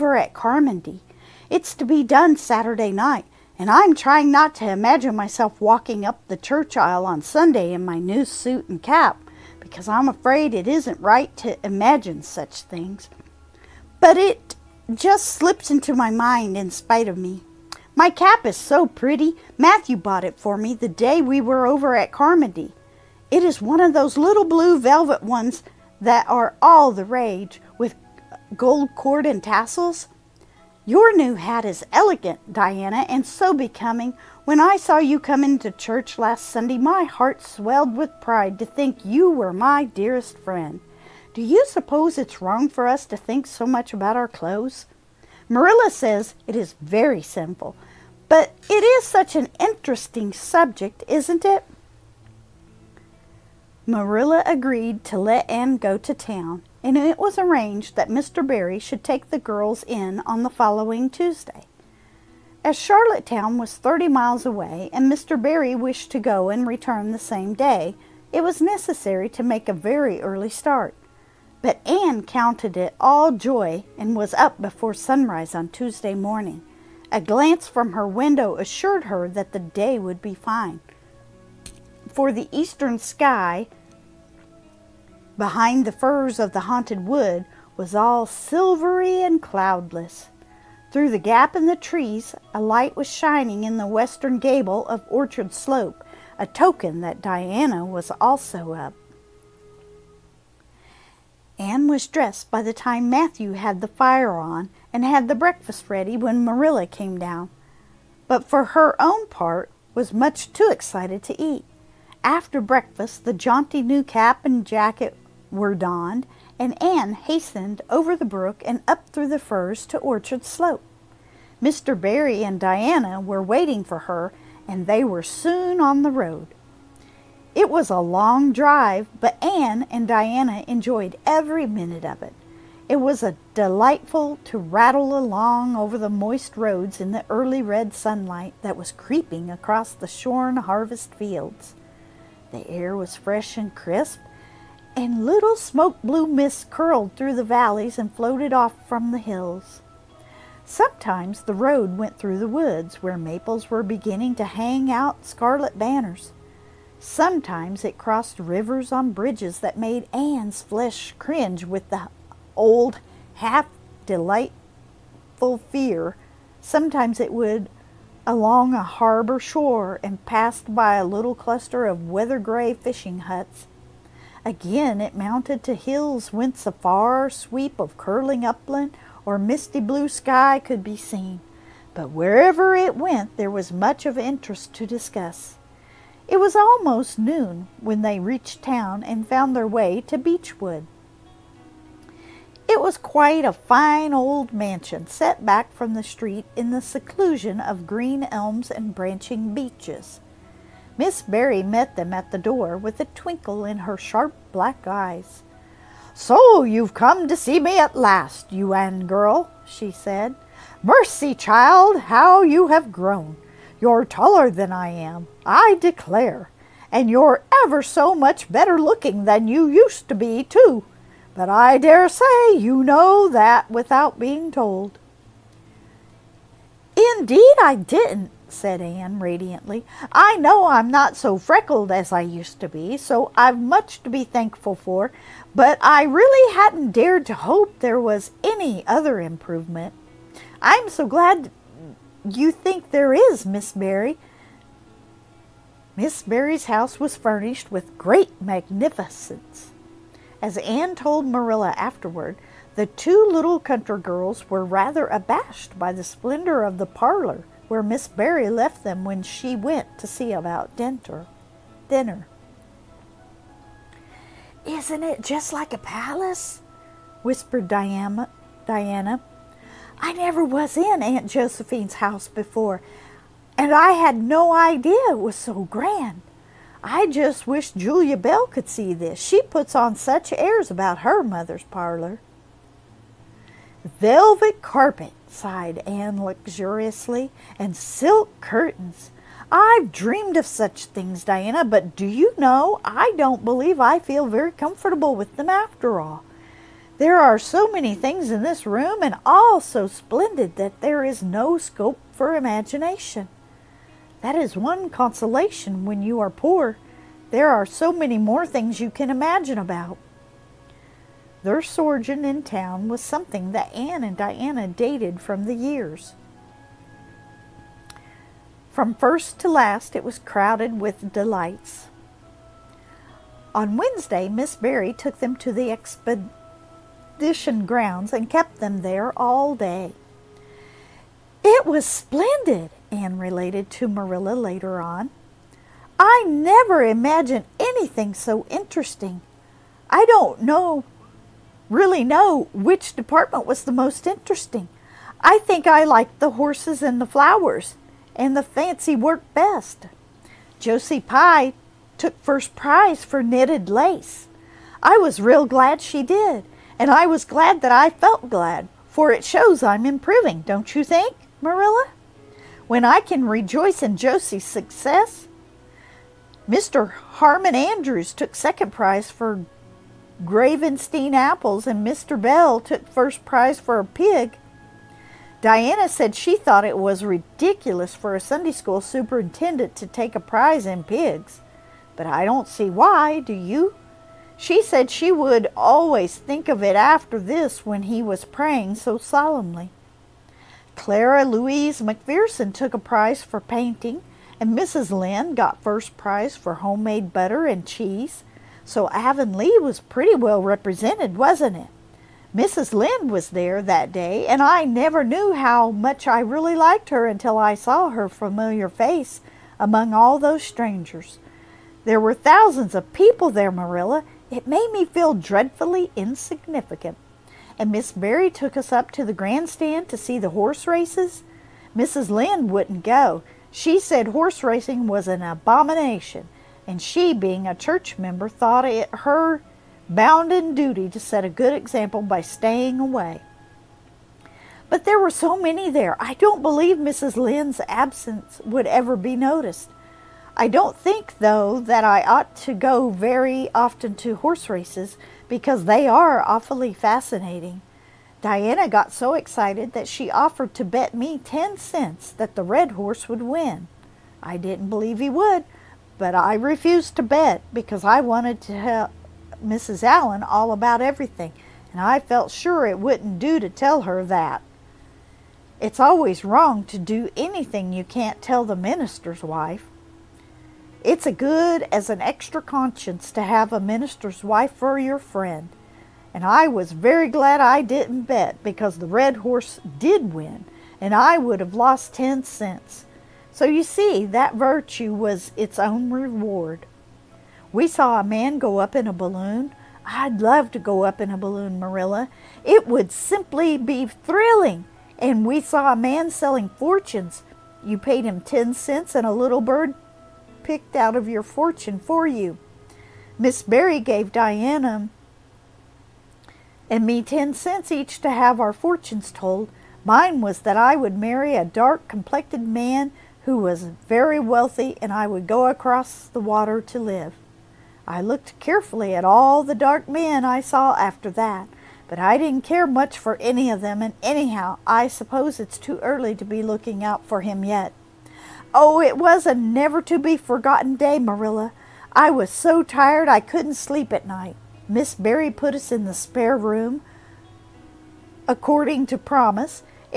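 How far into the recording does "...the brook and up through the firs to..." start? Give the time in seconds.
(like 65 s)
118 s.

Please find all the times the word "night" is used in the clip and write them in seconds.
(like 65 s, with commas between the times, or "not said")
2 s, 534 s.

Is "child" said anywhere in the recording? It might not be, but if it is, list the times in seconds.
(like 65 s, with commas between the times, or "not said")
211 s.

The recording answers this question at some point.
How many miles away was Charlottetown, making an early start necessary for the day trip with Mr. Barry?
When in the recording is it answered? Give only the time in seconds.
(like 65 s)
63 s.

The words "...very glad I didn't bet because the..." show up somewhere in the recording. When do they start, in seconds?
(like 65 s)
476 s.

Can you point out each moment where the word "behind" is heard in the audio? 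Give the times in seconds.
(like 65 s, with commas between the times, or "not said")
85 s.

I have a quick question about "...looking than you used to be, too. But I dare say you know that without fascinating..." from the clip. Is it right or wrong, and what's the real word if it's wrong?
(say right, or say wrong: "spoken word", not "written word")
wrong: "being", not "fascinating".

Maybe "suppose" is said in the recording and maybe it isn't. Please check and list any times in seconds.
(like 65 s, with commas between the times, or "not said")
41 s, 524 s.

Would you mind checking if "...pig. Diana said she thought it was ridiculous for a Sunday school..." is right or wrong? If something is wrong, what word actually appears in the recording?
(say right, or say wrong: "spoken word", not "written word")
right.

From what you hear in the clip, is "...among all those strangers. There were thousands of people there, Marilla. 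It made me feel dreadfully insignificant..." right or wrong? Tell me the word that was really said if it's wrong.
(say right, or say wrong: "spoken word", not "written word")
right.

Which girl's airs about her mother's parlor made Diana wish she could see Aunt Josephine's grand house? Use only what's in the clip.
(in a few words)
Julia Bell.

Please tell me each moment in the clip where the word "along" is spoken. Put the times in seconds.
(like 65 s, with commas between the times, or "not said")
135 s, 168 s.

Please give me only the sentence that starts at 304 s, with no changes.
That is one consolation when you are poor.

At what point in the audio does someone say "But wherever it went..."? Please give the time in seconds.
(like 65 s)
181 s.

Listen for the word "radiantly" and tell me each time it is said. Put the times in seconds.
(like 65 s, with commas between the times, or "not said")
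229 s.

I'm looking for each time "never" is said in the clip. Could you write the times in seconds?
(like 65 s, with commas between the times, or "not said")
270 s, 336 s, 404 s, 529 s.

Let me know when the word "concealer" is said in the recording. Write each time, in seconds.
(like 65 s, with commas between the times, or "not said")
not said.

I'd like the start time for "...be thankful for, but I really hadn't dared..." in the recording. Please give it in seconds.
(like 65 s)
234 s.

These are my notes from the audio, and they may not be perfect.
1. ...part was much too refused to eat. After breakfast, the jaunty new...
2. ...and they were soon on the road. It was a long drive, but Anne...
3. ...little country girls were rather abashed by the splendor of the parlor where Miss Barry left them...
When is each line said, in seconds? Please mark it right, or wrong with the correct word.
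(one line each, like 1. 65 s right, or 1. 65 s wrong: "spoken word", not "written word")
1. 109 s wrong: "excited", not "refused"
2. 124 s right
3. 253 s right.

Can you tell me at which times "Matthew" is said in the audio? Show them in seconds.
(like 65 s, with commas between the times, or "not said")
19 s, 103 s.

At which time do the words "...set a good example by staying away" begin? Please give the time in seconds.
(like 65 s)
430 s.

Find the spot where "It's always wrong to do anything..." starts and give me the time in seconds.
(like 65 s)
465 s.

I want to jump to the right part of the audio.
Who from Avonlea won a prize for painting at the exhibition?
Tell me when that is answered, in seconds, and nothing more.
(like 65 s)
390 s.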